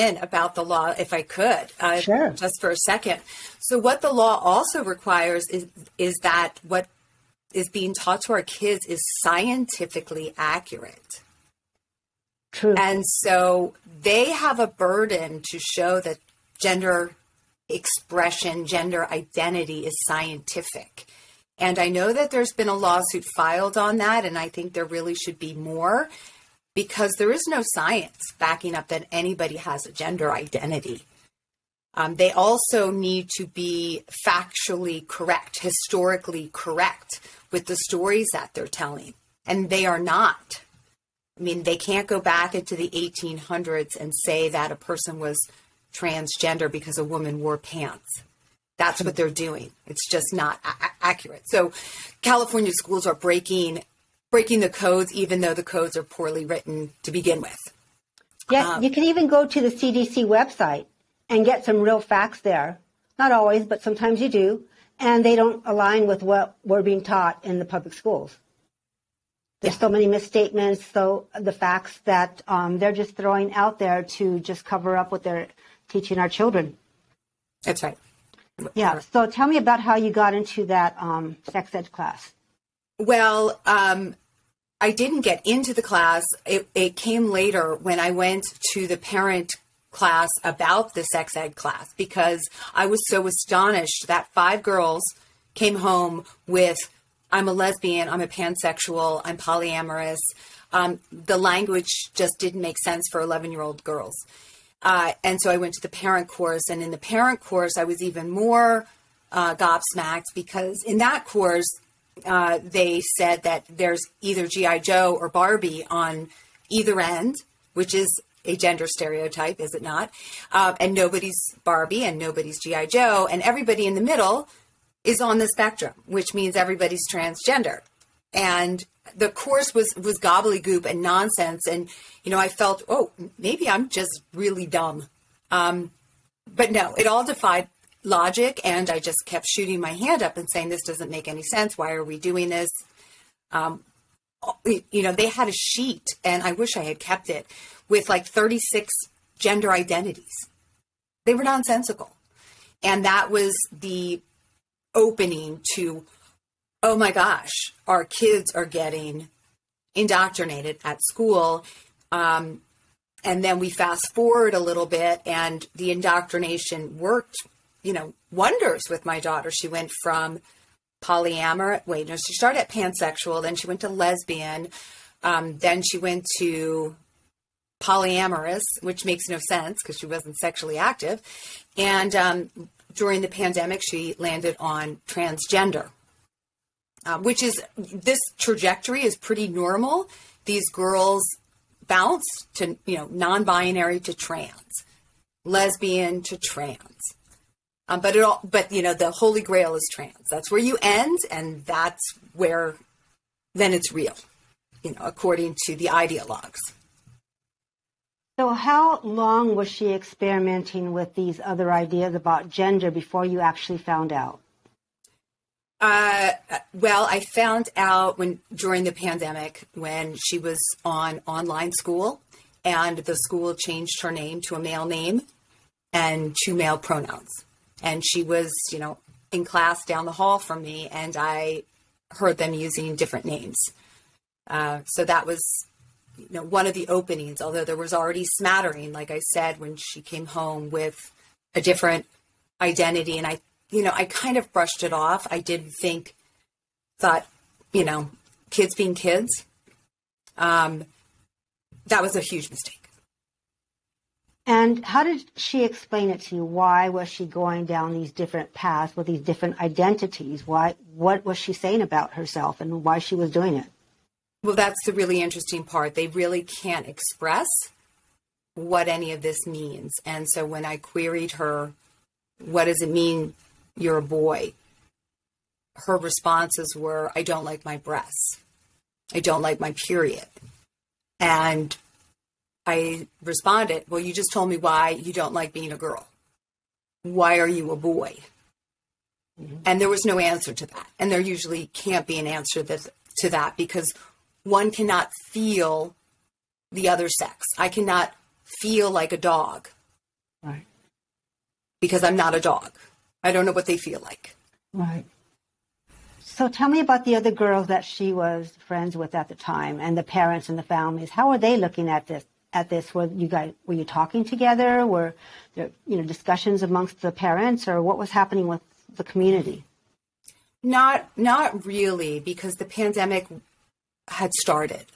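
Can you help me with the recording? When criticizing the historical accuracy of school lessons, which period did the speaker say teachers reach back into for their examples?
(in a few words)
1800s.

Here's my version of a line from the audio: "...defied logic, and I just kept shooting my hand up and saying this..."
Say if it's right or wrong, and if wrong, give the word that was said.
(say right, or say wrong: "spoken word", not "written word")
right.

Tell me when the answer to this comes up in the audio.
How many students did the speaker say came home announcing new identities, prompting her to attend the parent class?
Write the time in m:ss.
1:34.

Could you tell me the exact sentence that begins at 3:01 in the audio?
And um, during the pandemic, she landed on transgender, uh, which is this trajectory is pretty normal.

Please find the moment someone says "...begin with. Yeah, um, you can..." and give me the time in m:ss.
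0:57.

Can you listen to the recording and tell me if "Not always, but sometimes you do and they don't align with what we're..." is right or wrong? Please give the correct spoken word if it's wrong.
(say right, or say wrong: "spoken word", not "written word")
right.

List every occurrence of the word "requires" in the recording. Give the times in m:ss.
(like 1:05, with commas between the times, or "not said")
0:04.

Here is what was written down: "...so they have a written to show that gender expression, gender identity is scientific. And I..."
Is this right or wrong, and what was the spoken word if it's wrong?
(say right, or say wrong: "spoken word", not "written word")
wrong: "burden", not "written".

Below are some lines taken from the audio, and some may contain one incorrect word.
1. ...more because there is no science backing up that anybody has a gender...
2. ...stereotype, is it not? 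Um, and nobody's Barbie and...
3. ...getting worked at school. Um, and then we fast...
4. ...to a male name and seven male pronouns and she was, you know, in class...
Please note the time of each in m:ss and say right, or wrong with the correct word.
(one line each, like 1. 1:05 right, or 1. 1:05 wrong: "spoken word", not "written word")
1. 0:25 right
2. 1:58 right
3. 2:38 wrong: "indoctrinated", not "worked"
4. 3:44 wrong: "two", not "seven".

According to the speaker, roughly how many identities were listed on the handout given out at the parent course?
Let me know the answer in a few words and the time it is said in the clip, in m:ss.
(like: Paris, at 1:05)
36, at 2:28.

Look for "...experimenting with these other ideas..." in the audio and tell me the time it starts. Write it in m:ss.
3:29.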